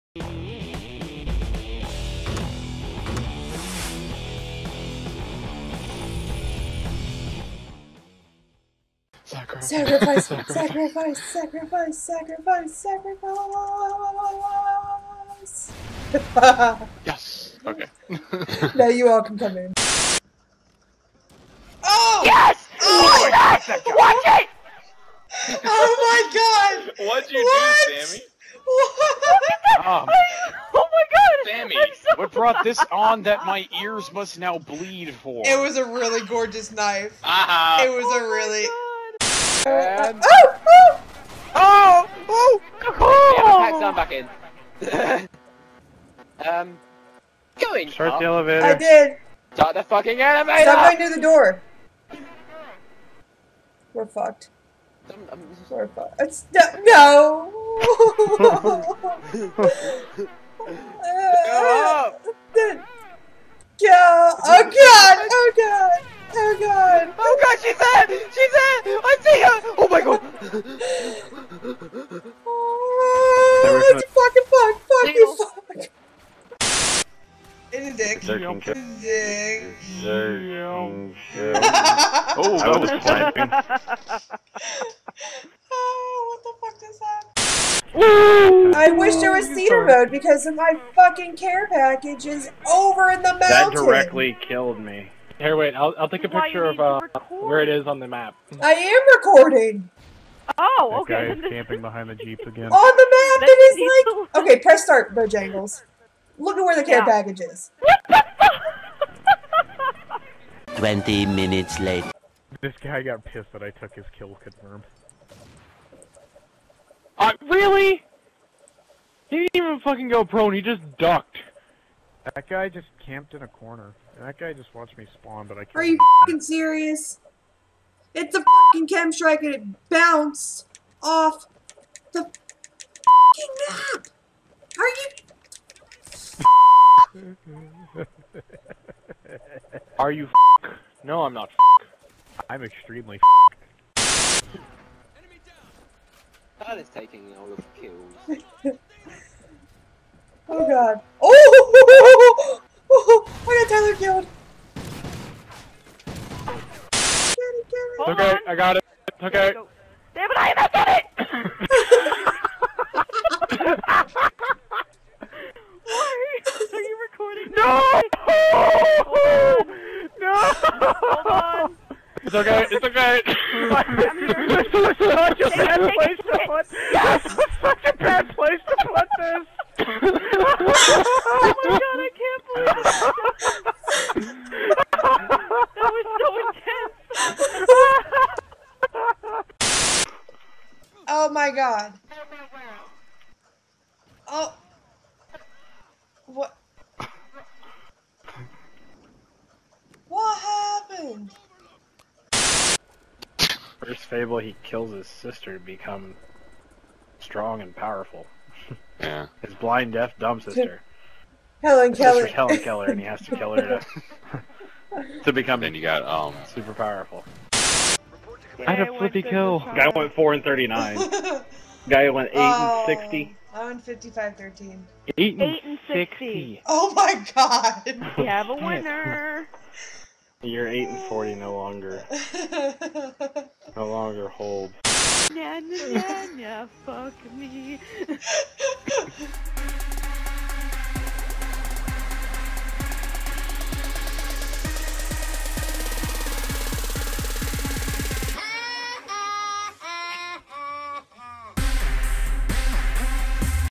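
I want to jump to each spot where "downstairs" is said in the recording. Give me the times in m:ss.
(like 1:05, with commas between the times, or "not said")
not said.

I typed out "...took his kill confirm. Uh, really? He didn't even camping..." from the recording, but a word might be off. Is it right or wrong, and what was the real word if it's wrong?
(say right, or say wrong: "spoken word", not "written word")
wrong: "fucking", not "camping".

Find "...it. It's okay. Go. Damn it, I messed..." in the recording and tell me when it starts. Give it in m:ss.
2:38.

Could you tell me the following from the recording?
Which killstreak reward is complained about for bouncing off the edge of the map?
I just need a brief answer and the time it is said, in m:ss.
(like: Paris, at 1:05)
KEM strike, at 2:08.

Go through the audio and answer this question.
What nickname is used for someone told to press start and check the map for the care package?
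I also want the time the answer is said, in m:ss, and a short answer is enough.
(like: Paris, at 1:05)
Bojangles, at 1:45.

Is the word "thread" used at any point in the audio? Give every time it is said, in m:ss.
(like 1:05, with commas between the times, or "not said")
not said.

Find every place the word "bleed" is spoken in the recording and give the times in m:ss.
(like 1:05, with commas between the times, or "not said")
0:34.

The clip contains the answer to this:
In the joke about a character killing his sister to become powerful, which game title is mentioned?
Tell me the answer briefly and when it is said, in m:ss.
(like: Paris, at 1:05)
Fable, at 3:24.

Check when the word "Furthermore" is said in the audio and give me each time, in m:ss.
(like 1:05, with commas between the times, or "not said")
not said.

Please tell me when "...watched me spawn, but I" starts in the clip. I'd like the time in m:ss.
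2:04.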